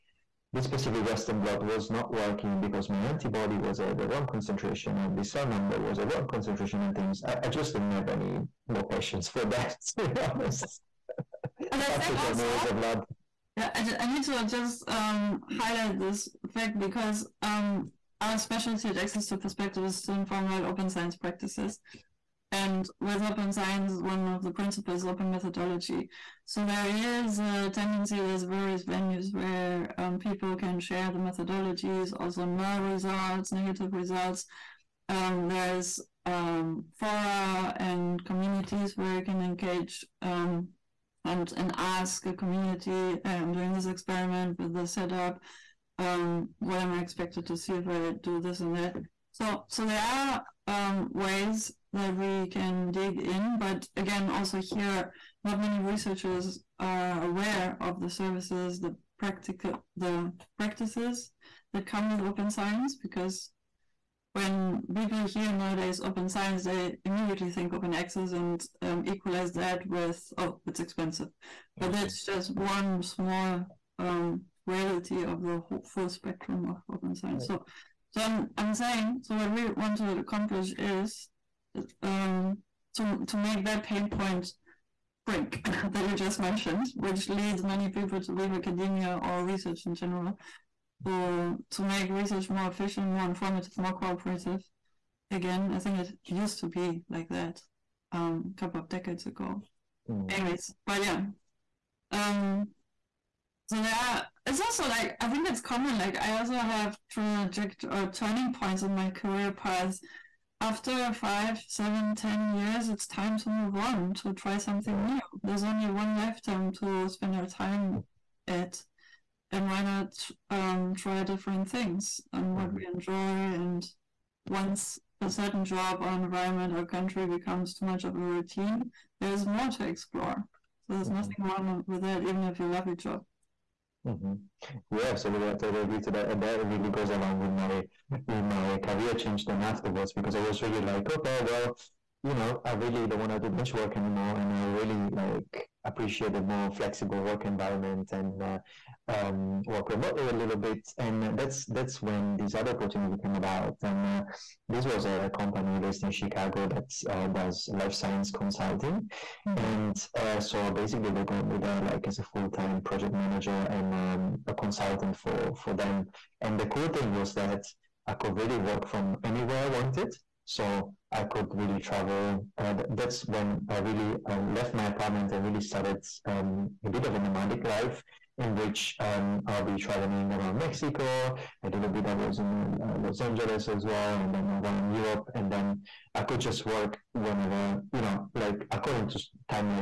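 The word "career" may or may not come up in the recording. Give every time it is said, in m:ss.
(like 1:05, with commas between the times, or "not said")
1:49, 2:18.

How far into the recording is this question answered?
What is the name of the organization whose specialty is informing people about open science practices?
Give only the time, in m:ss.
0:18.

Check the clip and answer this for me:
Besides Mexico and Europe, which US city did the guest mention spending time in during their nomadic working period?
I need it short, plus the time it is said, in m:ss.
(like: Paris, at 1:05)
Los Angeles, at 3:02.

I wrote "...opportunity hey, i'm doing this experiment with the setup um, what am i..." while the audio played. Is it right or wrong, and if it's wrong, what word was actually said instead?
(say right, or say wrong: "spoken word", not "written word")
wrong: "community", not "opportunity".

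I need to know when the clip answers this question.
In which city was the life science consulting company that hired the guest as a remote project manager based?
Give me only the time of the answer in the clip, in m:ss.
2:36.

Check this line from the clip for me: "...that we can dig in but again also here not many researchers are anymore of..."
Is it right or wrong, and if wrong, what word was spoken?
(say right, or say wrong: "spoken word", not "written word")
wrong: "aware", not "anymore".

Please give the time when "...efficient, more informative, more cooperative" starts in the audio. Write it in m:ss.
1:32.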